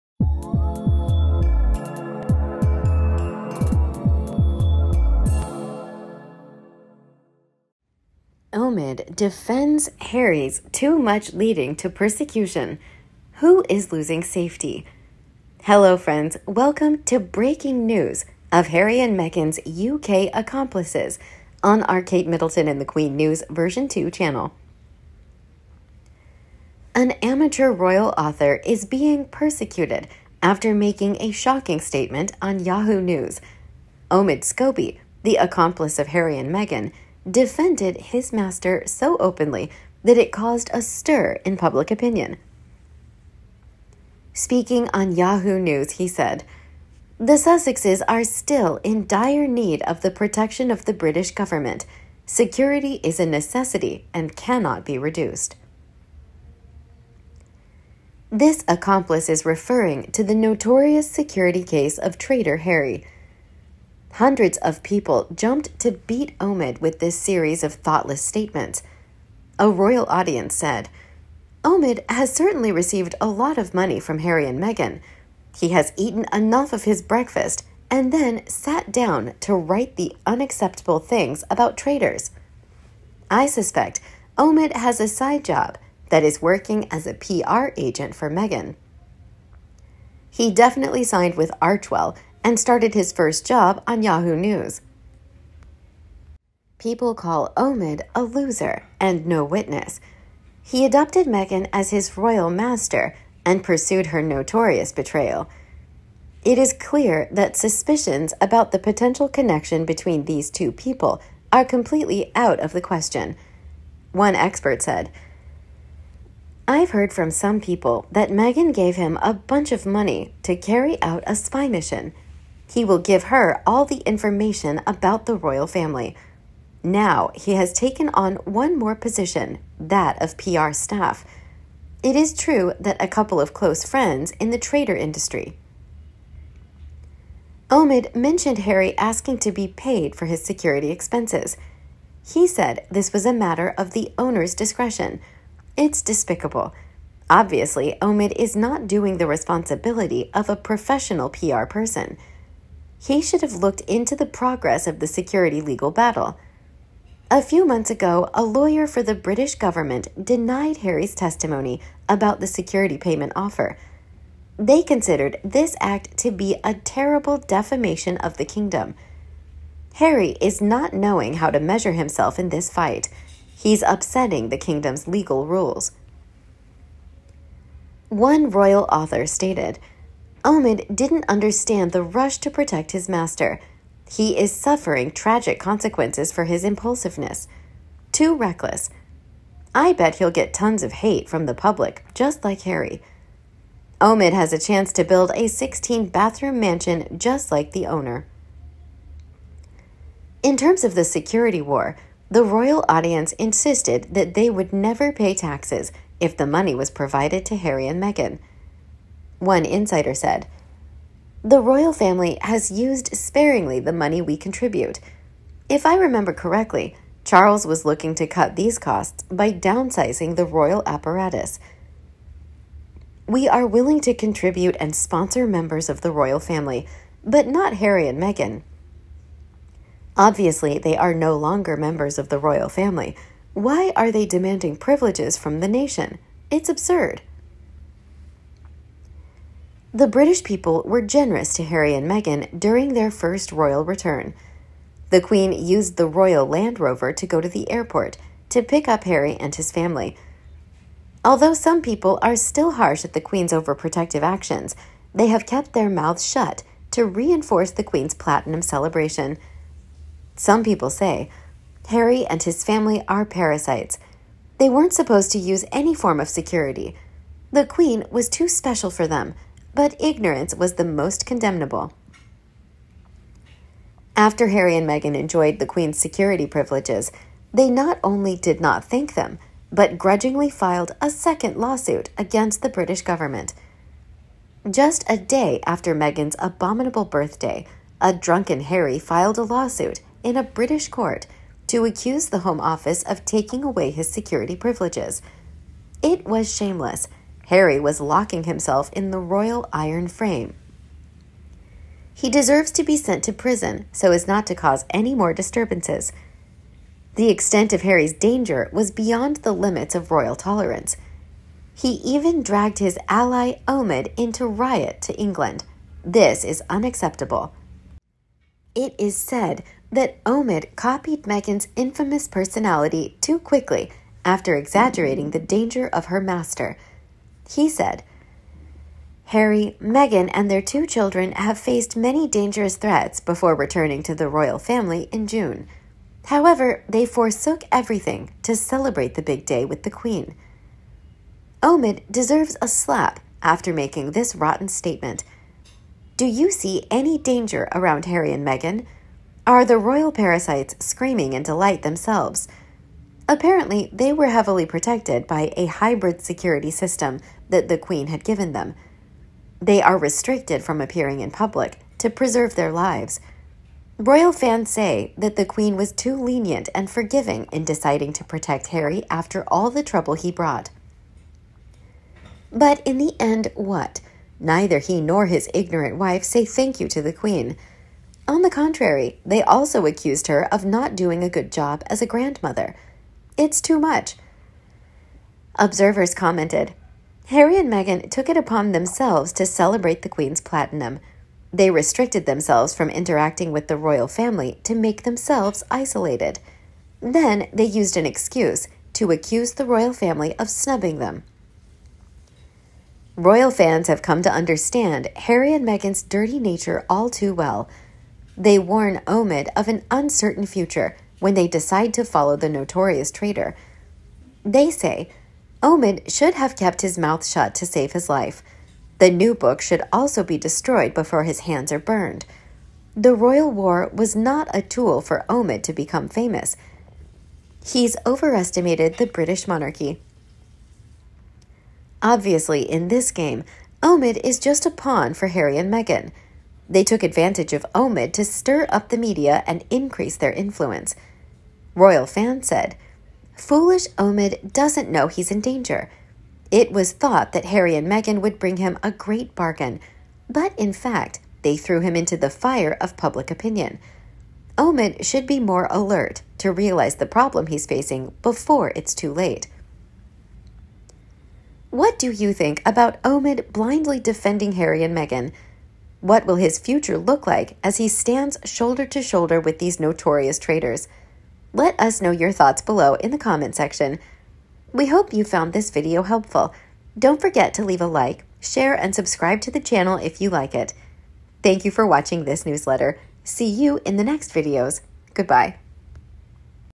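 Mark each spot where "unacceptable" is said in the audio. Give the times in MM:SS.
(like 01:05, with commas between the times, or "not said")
01:20, 05:16.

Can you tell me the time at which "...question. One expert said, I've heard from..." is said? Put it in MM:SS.
01:52.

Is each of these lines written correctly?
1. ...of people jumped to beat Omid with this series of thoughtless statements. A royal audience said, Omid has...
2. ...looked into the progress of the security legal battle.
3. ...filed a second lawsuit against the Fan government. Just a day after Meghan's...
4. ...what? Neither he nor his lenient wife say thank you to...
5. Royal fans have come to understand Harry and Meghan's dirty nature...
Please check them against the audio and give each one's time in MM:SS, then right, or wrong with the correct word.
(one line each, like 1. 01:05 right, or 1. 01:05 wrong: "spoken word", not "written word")
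1. 01:04 right
2. 02:33 right
3. 04:40 wrong: "British", not "Fan"
4. 06:13 wrong: "ignorant", not "lenient"
5. 06:43 right.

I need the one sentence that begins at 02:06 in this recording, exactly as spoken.
Now he has taken on one more position, that of PR staff.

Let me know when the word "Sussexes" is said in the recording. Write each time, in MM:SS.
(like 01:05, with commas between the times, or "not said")
00:47.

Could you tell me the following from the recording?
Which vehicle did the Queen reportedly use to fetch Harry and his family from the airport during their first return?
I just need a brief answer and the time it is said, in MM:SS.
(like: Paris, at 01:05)
Royal Land Rover, at 04:06.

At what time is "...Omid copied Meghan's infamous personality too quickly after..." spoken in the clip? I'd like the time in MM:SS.
05:20.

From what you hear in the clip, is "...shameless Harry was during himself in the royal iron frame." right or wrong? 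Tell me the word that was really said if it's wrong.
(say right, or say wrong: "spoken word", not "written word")
wrong: "locking", not "during".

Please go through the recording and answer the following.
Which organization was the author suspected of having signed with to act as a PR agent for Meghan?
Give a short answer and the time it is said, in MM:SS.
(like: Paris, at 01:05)
Archewell, at 01:31.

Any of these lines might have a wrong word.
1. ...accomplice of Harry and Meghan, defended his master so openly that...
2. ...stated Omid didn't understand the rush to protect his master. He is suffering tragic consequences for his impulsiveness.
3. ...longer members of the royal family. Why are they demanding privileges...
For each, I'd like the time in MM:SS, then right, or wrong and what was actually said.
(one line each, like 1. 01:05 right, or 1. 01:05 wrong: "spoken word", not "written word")
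1. 00:35 right
2. 02:59 right
3. 03:51 right.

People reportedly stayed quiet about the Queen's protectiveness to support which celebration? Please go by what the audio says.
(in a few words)
platinum celebration.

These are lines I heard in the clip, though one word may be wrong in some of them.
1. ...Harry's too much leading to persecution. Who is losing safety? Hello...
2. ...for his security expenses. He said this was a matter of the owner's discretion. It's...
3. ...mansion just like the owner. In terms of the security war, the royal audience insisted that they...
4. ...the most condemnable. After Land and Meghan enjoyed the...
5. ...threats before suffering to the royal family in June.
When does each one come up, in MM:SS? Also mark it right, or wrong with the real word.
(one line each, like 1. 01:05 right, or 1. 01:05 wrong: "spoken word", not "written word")
1. 00:09 right
2. 02:20 right
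3. 03:16 right
4. 04:30 wrong: "Harry", not "Land"
5. 05:32 wrong: "returning", not "suffering".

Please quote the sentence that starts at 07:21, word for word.
Royal Fan said, Foolish Omid doesn't know he's in danger.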